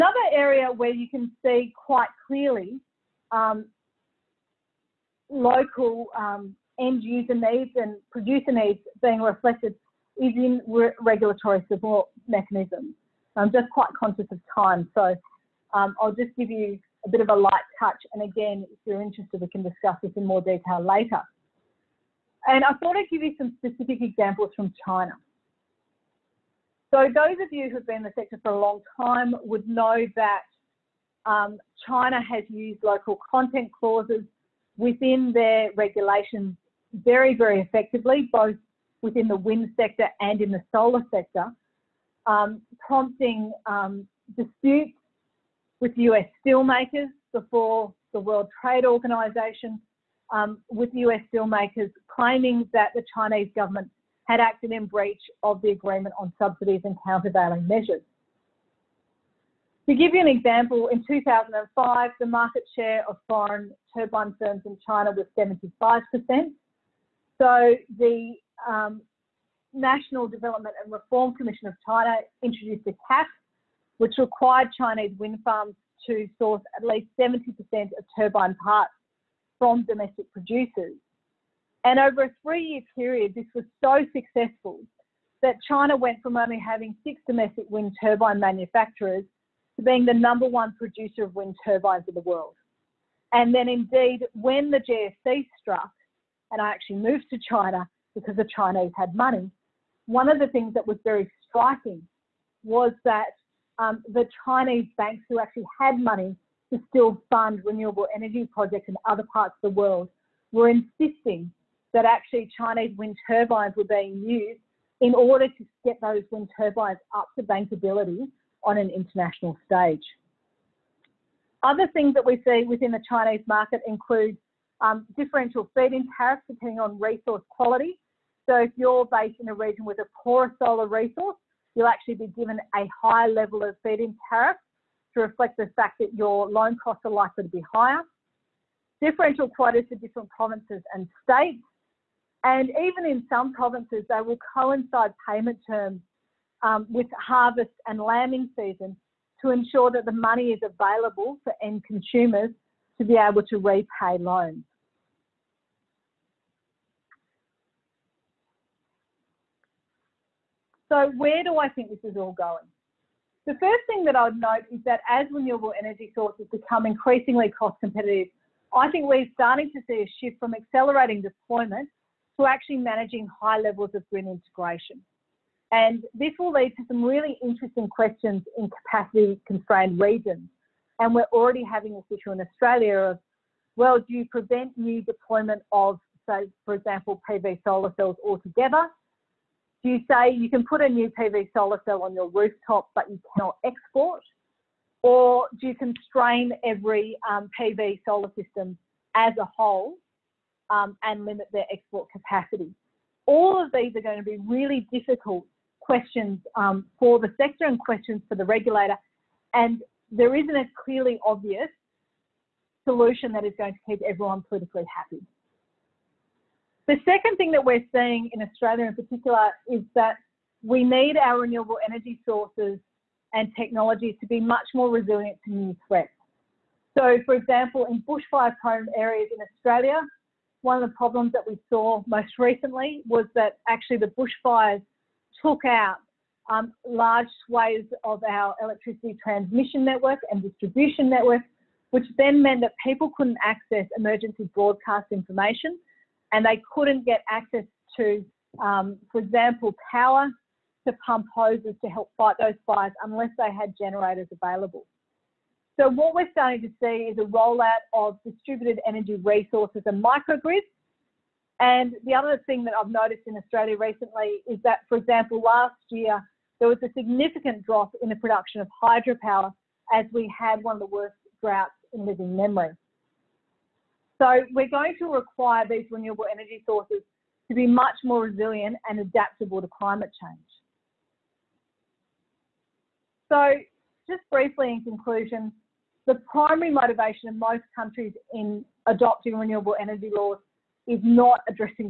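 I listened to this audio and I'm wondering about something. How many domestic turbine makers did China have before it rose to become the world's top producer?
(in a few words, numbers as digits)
six.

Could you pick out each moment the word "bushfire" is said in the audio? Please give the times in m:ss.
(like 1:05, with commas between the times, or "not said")
3:48, 3:54.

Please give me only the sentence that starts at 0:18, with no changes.
And again, if you're interested, we can discuss this in more detail later.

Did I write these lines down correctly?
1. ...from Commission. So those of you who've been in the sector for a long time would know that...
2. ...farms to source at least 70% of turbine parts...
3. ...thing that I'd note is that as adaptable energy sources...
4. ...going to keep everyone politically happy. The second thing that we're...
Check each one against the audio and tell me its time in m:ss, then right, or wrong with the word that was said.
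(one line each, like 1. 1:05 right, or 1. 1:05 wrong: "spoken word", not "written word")
1. 0:24 wrong: "China", not "Commission"
2. 1:15 right
3. 2:43 wrong: "renewable", not "adaptable"
4. 3:33 right.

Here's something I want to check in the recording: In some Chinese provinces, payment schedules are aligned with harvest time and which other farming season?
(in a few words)
lambing season.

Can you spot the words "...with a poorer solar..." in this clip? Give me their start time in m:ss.
2:09.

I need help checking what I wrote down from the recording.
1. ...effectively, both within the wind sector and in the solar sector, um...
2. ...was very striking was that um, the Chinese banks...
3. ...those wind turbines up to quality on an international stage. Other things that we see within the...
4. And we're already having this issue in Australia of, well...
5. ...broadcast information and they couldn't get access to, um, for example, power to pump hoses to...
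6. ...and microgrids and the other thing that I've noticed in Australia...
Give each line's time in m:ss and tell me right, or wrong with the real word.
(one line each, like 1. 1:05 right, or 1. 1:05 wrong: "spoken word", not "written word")
1. 0:37 right
2. 1:40 right
3. 1:56 wrong: "bankability", not "quality"
4. 3:00 right
5. 4:04 right
6. 4:19 right.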